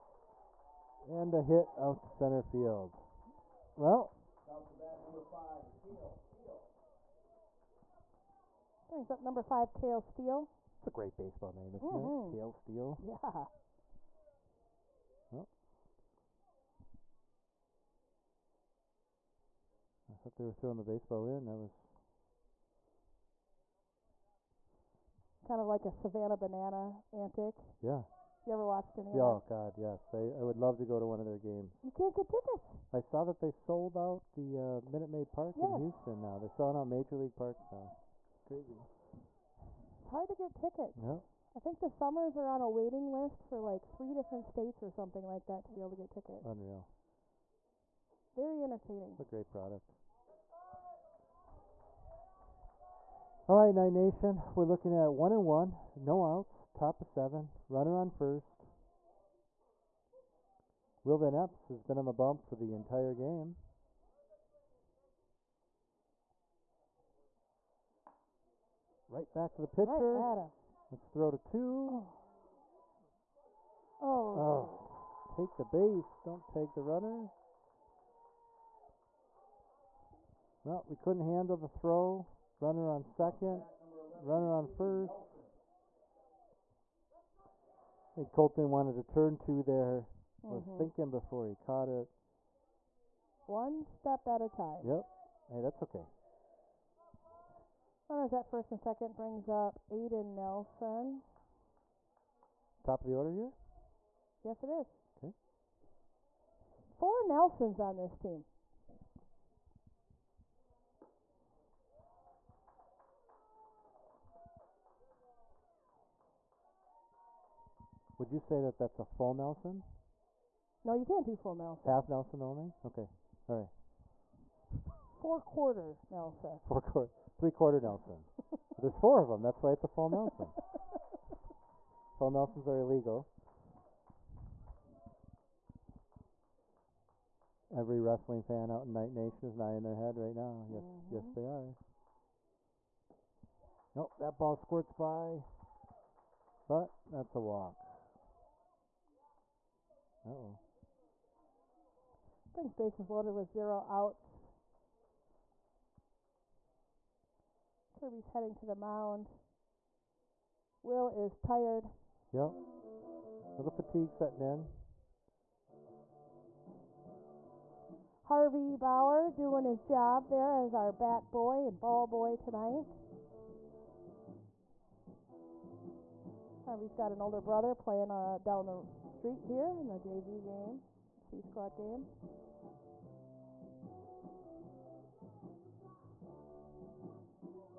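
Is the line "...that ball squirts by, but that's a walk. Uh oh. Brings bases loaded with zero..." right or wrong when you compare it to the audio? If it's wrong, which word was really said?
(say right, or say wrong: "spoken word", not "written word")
right.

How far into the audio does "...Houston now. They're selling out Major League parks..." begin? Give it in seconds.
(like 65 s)
35 s.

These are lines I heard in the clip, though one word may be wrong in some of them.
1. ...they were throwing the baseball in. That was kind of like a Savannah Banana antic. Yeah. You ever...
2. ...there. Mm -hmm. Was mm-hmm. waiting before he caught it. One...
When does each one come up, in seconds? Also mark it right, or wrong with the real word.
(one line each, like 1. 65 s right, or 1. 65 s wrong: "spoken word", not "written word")
1. 20 s right
2. 89 s wrong: "thinking", not "waiting".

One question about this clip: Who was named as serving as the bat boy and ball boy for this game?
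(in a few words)
Harvey Bauer.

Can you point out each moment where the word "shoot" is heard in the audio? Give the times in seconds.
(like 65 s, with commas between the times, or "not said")
74 s.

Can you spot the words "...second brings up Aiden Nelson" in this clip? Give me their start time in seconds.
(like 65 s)
98 s.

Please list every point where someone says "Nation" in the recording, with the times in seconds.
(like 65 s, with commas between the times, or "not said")
53 s, 139 s.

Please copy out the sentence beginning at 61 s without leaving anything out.
Will Van Epps has been on the bump for the entire game.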